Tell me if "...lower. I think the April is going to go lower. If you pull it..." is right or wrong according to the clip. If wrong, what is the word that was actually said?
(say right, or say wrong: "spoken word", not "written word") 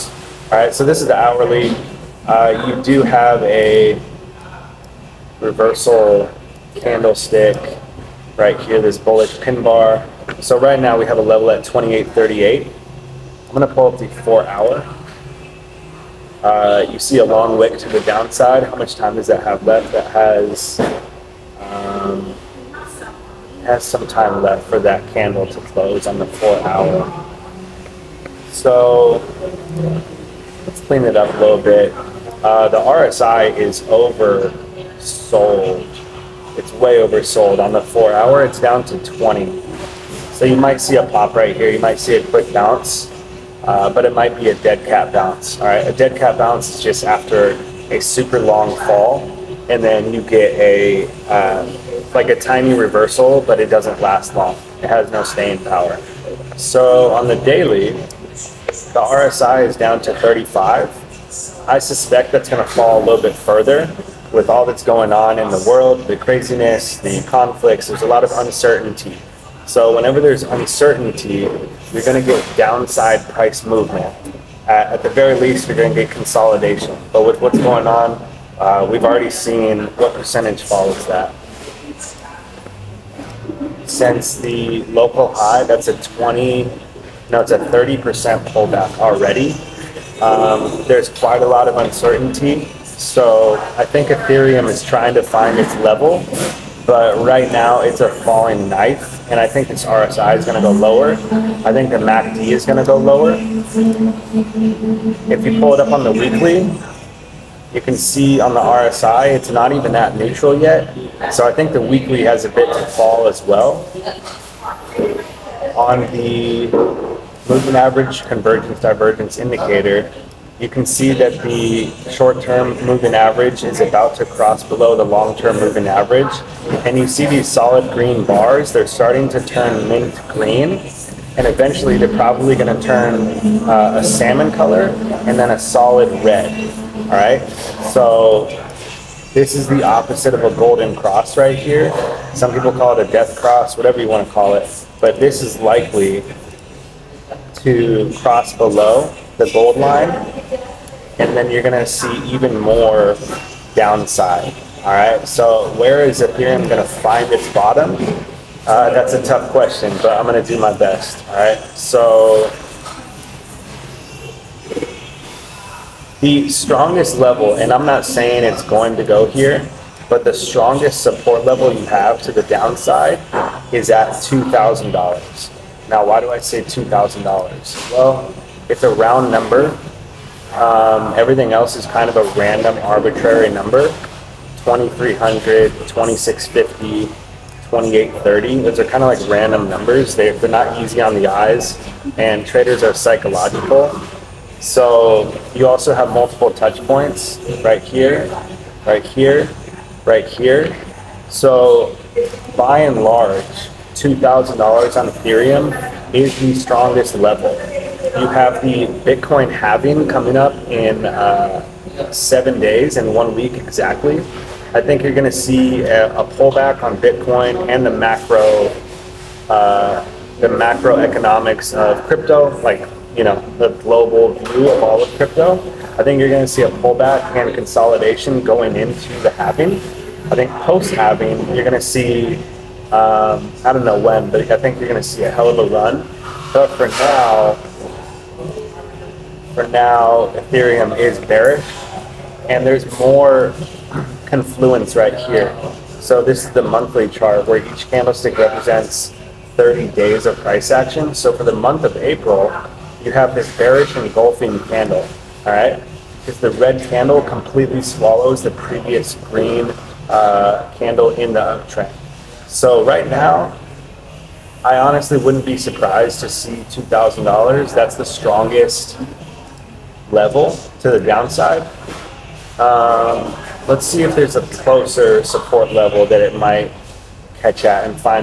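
wrong: "MACD", not "April".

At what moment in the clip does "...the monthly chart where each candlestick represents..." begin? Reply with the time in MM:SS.
04:06.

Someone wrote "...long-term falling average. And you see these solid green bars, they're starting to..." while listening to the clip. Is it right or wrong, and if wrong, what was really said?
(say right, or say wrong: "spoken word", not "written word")
wrong: "moving", not "falling".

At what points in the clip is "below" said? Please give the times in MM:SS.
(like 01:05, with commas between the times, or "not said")
02:04, 02:28.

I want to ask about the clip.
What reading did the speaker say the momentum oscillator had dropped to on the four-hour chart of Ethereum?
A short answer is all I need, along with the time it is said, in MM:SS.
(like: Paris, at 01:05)
20, at 00:38.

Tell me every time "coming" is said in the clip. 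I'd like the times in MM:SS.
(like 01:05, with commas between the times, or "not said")
03:30.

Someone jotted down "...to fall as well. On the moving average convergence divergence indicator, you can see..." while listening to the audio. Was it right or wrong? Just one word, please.
right.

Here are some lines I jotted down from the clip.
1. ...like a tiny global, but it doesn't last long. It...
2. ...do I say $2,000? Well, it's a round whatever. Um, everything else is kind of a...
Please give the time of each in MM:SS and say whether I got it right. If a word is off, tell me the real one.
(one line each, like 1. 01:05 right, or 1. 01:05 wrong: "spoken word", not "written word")
1. 00:52 wrong: "reversal", not "global"
2. 02:56 wrong: "number", not "whatever".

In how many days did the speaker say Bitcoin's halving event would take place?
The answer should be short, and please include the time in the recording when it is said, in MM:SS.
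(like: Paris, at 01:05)
7, at 03:32.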